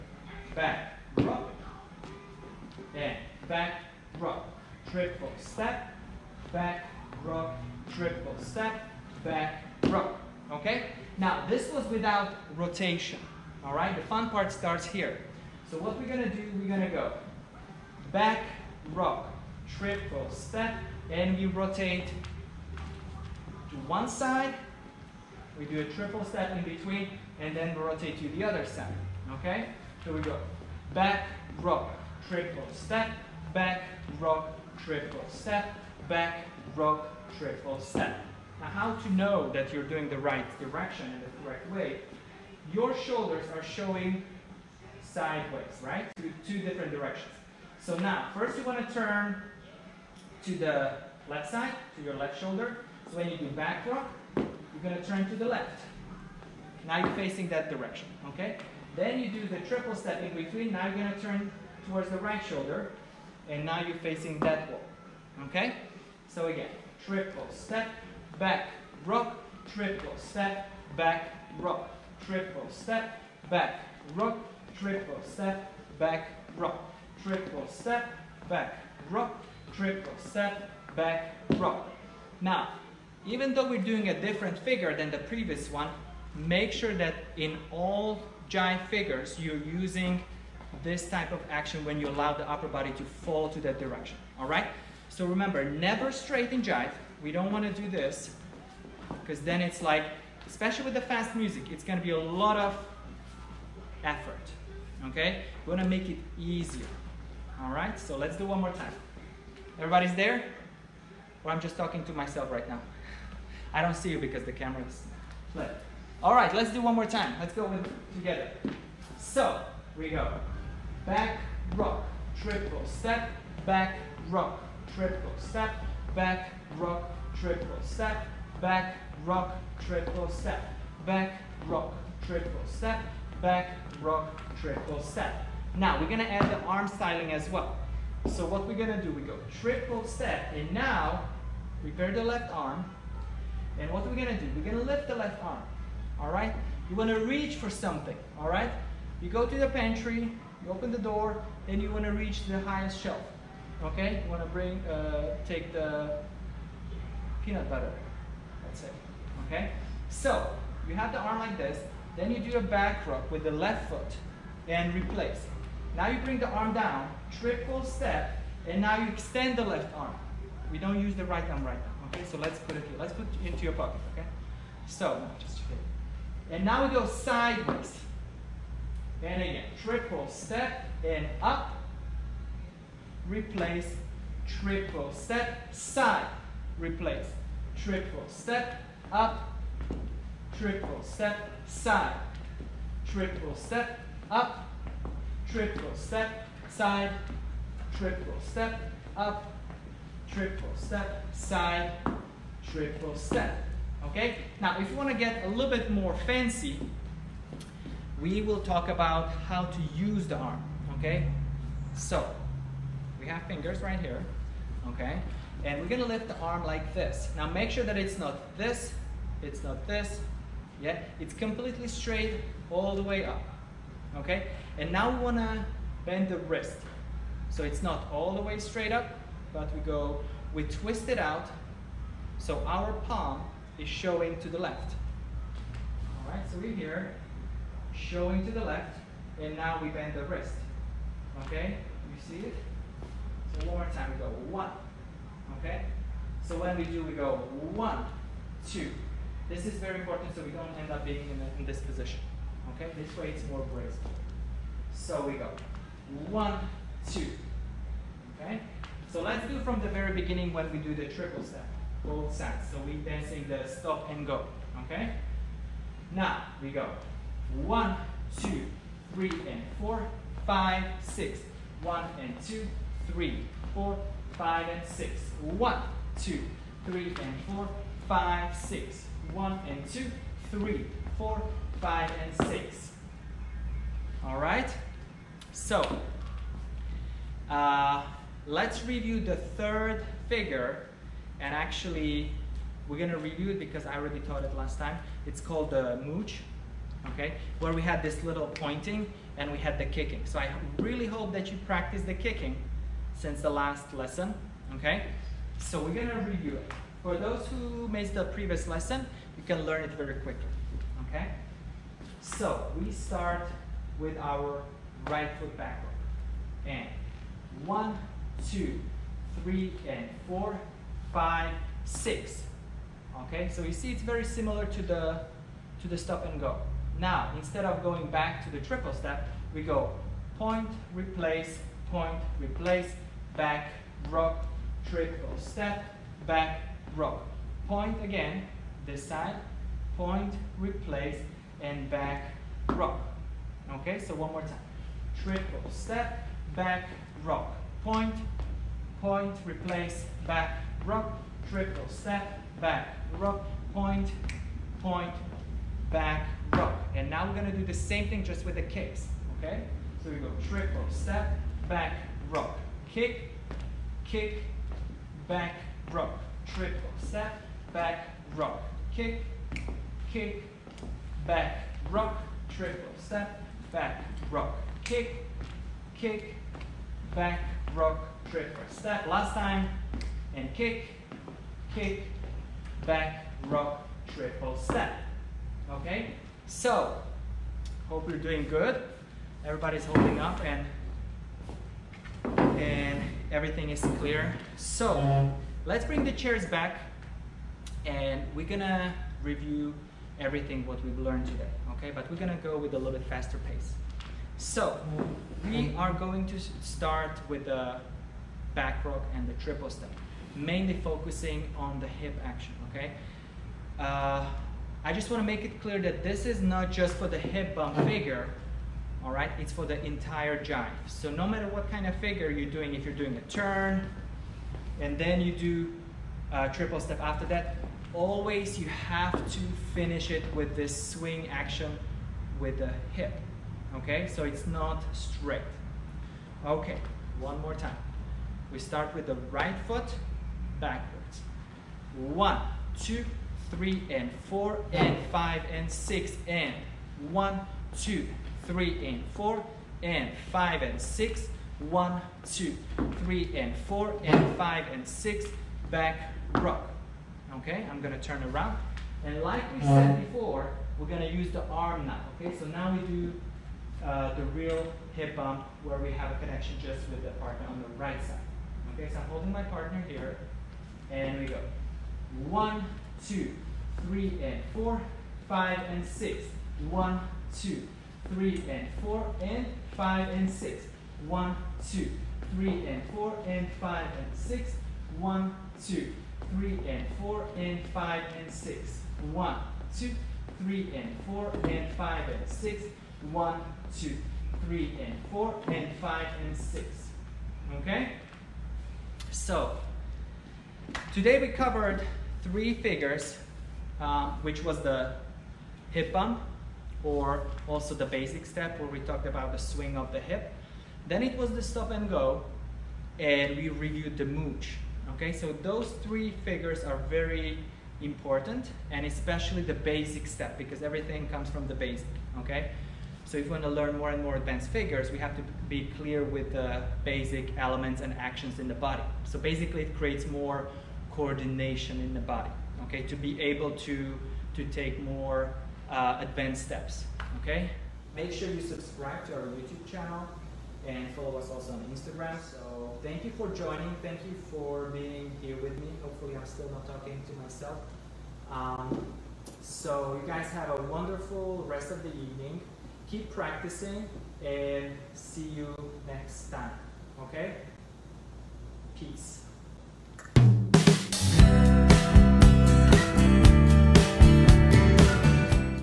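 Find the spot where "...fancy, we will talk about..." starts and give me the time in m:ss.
3:26.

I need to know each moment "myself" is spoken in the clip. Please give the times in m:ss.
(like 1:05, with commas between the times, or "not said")
1:52, 9:07.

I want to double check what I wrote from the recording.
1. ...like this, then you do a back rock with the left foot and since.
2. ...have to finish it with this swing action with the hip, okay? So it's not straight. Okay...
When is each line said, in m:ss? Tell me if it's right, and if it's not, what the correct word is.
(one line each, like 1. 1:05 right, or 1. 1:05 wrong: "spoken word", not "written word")
1. 2:41 wrong: "replace", not "since"
2. 7:08 right.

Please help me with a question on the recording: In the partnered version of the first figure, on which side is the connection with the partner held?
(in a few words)
right side.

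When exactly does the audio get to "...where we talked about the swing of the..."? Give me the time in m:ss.
8:28.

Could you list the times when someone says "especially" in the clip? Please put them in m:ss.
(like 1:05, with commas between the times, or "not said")
1:40, 8:38.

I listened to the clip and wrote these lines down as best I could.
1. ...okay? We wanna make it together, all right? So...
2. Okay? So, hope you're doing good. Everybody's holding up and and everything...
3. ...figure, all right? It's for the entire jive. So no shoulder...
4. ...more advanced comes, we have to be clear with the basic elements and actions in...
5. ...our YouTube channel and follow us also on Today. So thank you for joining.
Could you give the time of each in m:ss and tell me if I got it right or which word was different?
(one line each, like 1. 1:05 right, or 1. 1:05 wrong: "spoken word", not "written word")
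1. 1:45 wrong: "easier", not "together"
2. 6:25 right
3. 6:57 wrong: "matter", not "shoulder"
4. 8:44 wrong: "figures", not "comes"
5. 8:59 wrong: "Instagram", not "Today".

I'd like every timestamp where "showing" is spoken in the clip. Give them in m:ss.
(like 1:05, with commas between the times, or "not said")
0:43, 3:53, 3:57.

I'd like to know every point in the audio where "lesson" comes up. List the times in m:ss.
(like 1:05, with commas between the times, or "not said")
5:03, 5:08.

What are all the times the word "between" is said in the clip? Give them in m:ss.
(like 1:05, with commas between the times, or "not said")
0:26, 1:00.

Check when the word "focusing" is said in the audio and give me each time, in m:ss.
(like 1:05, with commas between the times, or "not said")
6:50.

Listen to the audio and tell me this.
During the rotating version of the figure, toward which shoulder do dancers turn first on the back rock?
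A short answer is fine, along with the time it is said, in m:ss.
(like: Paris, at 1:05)
left shoulder, at 0:51.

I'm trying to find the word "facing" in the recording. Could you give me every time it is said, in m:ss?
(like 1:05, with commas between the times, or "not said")
0:57, 1:03.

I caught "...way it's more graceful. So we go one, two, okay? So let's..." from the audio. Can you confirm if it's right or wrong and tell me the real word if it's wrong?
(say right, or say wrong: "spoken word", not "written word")
right.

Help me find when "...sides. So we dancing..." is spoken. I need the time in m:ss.
4:22.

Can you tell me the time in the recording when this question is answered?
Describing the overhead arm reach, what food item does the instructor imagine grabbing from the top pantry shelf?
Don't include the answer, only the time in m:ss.
2:37.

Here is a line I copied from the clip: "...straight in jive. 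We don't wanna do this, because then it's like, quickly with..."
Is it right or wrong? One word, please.
wrong.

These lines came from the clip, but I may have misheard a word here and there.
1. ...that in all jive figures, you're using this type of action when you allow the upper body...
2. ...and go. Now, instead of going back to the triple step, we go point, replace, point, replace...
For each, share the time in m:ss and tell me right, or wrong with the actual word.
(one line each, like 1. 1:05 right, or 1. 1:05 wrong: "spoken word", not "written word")
1. 1:26 right
2. 5:26 right.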